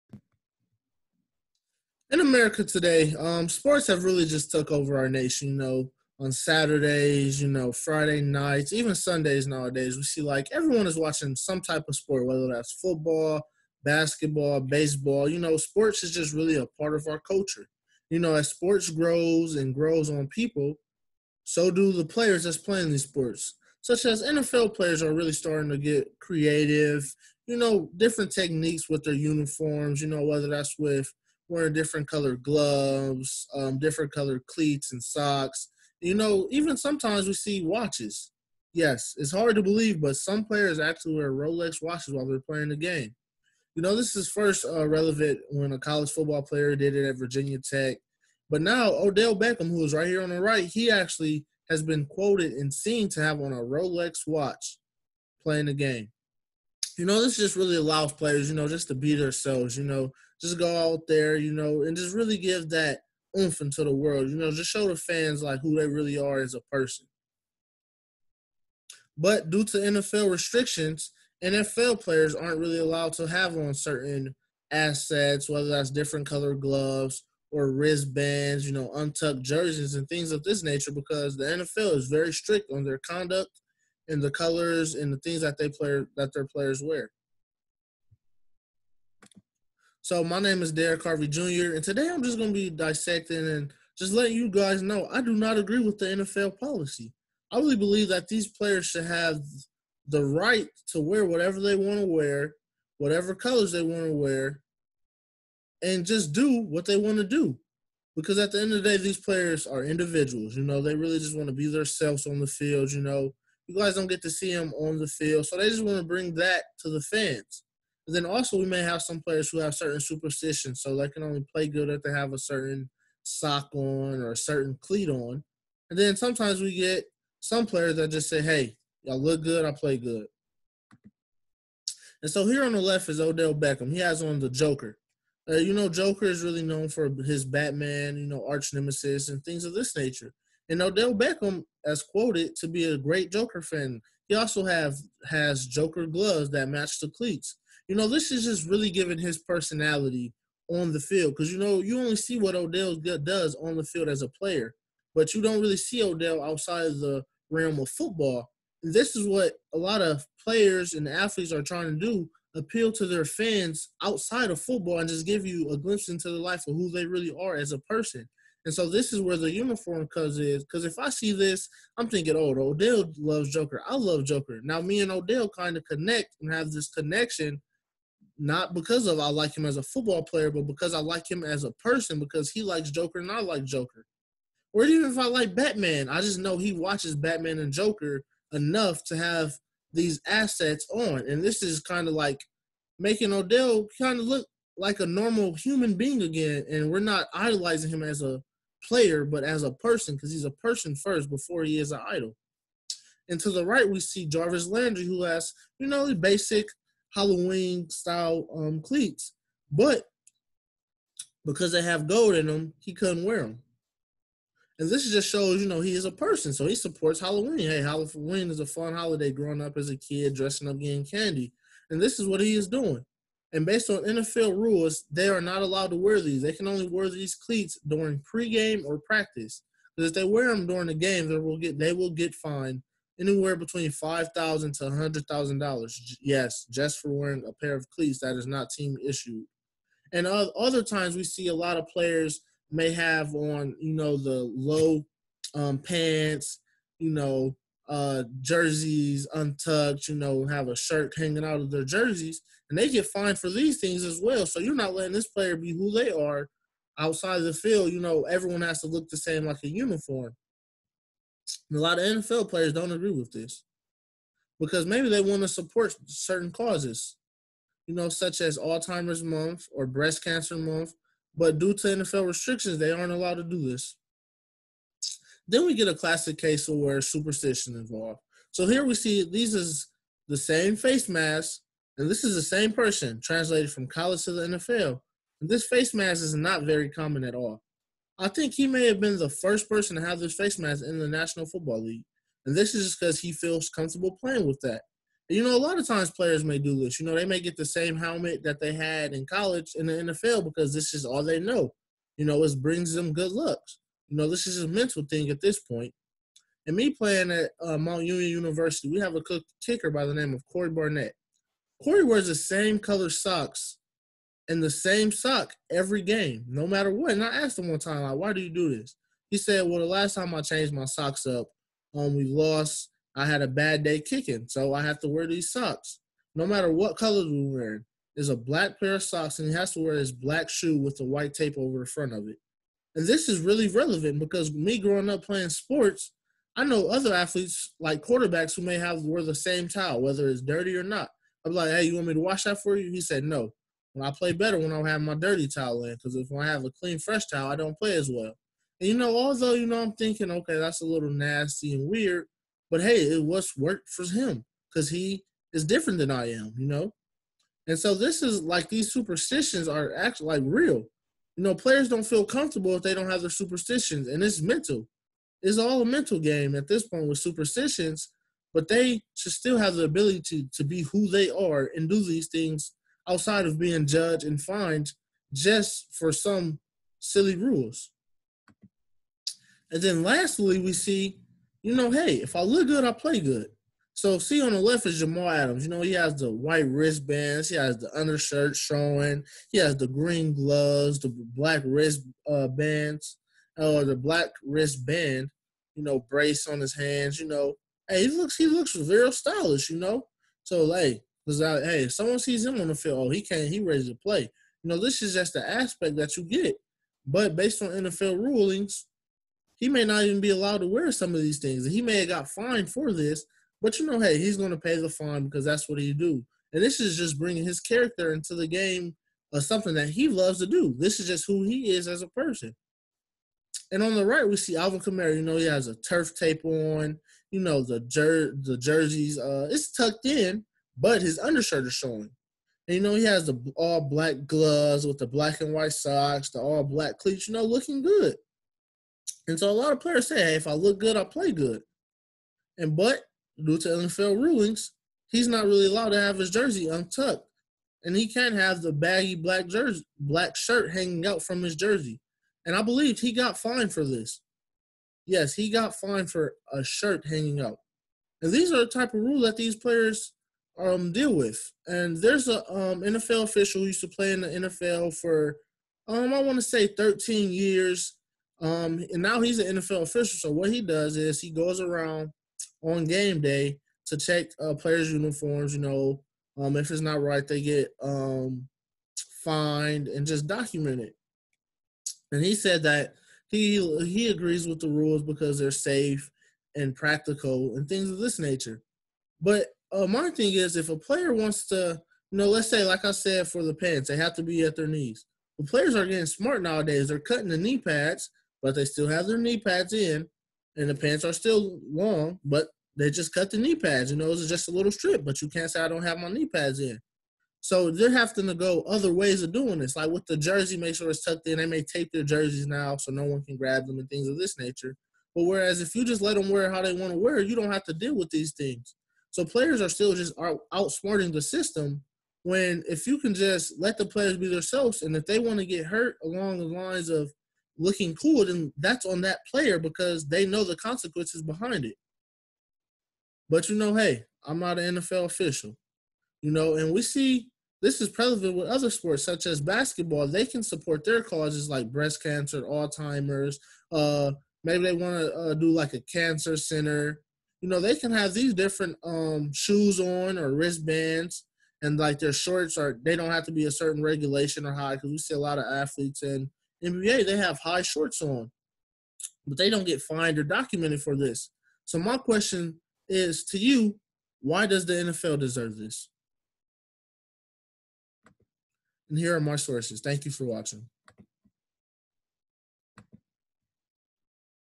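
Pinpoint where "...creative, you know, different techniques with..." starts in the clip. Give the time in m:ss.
0:26.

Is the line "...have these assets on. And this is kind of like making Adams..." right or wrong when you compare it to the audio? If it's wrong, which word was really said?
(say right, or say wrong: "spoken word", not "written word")
wrong: "Odell", not "Adams".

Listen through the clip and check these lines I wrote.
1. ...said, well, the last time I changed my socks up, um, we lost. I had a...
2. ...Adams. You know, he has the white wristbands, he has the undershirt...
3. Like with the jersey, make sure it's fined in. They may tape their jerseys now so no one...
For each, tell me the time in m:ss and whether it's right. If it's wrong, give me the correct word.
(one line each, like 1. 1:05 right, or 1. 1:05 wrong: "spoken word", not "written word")
1. 5:19 right
2. 6:25 right
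3. 8:29 wrong: "tucked", not "fined".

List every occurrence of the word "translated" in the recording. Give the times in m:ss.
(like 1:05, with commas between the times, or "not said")
4:43.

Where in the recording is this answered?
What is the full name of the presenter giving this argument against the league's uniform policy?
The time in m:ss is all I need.
1:30.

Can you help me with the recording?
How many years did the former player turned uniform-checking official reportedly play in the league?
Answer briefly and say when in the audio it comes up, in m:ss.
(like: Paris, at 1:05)
13, at 7:46.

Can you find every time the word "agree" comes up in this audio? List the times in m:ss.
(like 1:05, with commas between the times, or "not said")
1:35, 4:22, 8:04.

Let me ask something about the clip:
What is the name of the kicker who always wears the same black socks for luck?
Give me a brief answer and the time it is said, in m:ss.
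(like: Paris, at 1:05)
Corey Barnett, at 5:10.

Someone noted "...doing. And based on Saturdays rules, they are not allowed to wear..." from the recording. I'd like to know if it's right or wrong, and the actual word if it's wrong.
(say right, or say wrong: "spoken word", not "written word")
wrong: "NFL", not "Saturdays".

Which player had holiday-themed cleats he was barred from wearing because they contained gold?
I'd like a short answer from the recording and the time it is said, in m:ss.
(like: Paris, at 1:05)
Jarvis Landry, at 3:24.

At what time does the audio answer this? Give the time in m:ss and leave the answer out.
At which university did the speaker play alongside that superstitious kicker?
5:07.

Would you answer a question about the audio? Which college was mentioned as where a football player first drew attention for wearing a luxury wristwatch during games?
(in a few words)
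Virginia Tech.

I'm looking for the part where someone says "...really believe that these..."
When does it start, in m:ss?
1:37.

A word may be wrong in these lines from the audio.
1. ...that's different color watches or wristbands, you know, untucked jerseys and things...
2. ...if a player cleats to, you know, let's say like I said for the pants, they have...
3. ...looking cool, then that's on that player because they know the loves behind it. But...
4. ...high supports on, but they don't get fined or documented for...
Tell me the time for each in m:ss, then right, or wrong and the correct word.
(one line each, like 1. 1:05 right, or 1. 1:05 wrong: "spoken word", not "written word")
1. 1:15 wrong: "gloves", not "watches"
2. 8:10 wrong: "wants", not "cleats"
3. 8:47 wrong: "consequences", not "loves"
4. 9:17 wrong: "shorts", not "supports".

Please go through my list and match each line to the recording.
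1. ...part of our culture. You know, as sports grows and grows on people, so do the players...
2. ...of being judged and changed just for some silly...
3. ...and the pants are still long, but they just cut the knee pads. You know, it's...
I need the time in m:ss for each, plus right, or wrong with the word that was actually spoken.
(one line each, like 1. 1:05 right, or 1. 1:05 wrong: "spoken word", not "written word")
1. 0:16 right
2. 6:13 wrong: "fined", not "changed"
3. 8:20 right.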